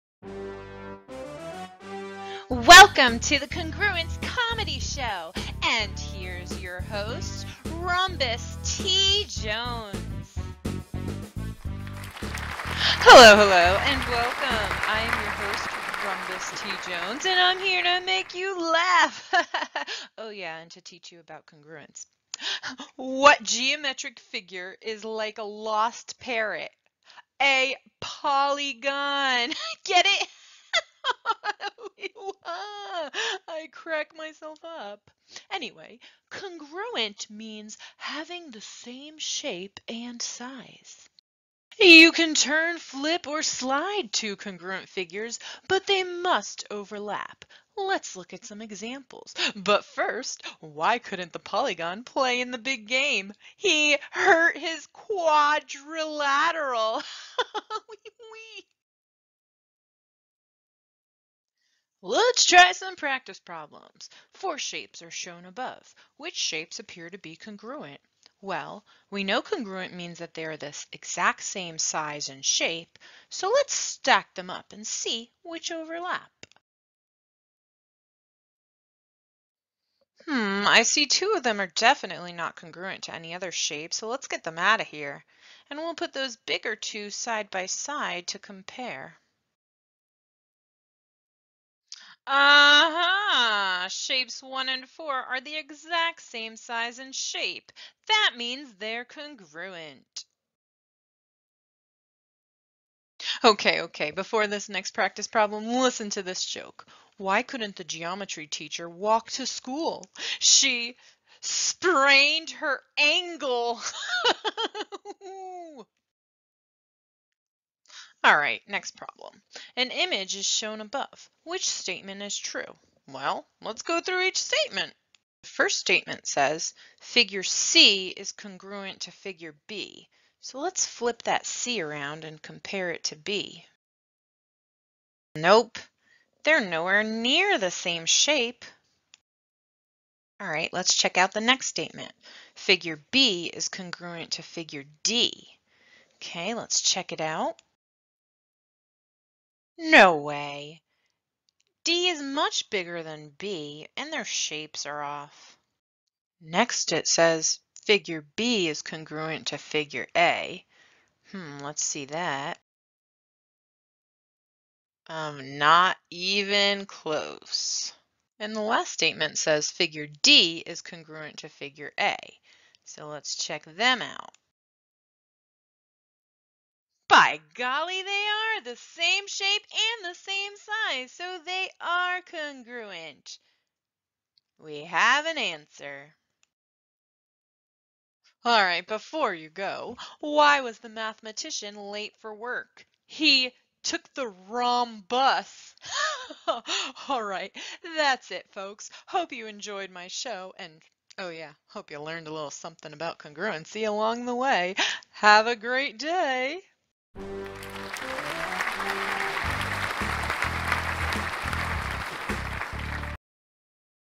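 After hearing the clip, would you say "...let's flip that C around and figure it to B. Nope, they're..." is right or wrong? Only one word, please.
wrong.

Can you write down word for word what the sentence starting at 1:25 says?
And we'll put those bigger two side by side to compare.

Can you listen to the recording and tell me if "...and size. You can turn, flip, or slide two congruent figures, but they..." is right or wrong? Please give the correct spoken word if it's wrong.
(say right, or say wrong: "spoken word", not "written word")
right.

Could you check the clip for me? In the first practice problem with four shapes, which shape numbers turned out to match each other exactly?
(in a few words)
1 and 4.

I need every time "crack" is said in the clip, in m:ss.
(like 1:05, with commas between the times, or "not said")
0:33.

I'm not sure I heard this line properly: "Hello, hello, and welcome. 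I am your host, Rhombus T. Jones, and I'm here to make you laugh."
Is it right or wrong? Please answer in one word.
right.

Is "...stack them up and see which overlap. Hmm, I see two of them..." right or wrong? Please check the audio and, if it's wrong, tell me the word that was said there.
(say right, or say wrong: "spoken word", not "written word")
right.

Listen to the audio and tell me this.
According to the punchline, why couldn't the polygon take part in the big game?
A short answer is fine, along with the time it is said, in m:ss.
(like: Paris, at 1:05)
He hurt his quadrilateral, at 0:53.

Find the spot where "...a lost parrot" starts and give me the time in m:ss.
0:25.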